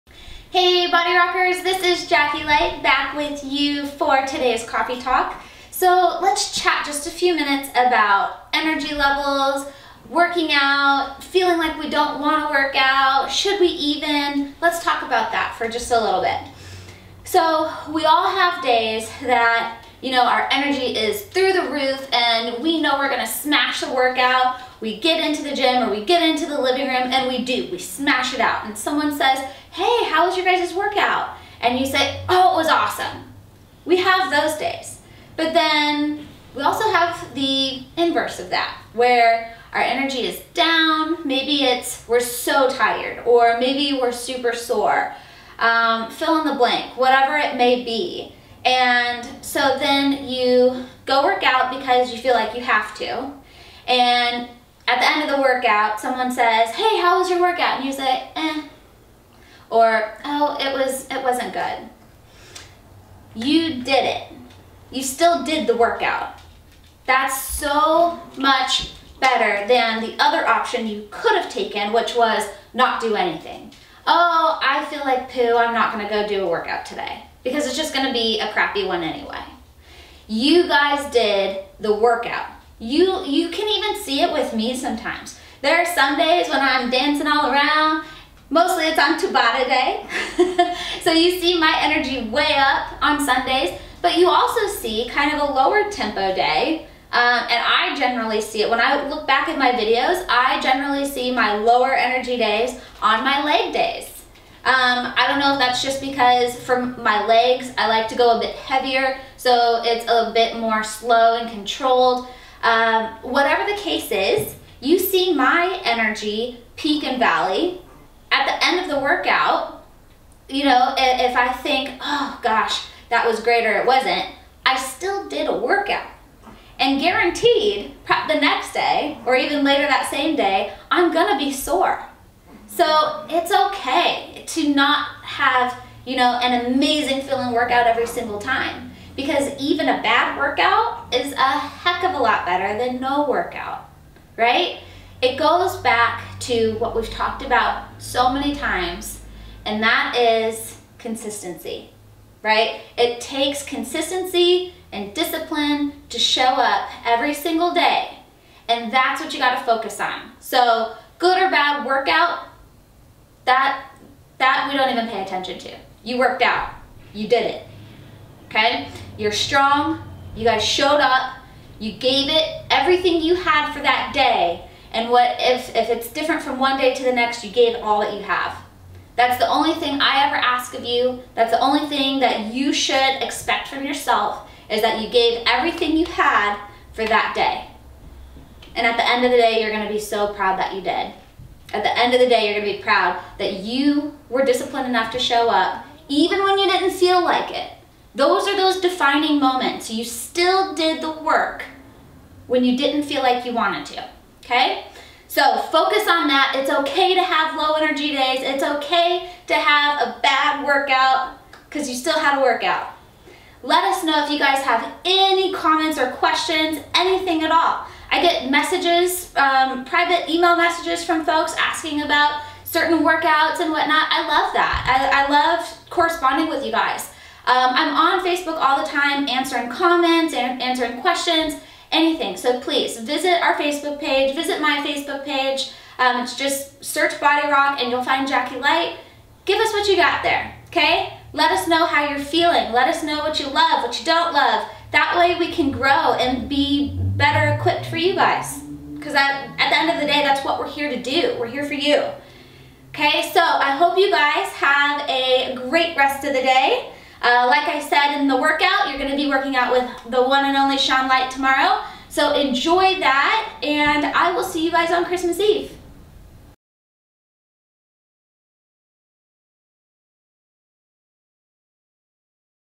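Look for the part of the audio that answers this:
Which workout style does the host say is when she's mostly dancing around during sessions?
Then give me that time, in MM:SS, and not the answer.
01:29.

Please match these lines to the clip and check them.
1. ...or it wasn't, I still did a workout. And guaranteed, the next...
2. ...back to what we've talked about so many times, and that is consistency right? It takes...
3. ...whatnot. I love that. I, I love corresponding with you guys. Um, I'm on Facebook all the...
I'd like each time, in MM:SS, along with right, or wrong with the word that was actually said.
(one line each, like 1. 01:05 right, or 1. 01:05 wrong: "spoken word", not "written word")
1. 02:03 right
2. 02:25 right
3. 03:43 right.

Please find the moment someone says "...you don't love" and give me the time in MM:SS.
04:03.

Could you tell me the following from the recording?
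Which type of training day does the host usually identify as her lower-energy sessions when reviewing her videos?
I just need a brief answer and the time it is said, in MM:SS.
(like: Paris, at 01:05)
Leg days, at 01:43.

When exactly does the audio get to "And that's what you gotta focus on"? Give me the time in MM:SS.
02:38.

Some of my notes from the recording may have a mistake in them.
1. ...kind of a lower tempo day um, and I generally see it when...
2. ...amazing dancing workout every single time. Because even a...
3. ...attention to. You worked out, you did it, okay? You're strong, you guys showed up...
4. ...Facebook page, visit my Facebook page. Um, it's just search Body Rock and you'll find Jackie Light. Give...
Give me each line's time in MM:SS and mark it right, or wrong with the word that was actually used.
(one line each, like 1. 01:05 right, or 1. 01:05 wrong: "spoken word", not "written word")
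1. 01:35 right
2. 02:16 wrong: "feeling", not "dancing"
3. 02:45 right
4. 03:53 right.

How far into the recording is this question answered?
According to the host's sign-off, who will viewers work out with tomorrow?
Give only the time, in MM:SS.
04:20.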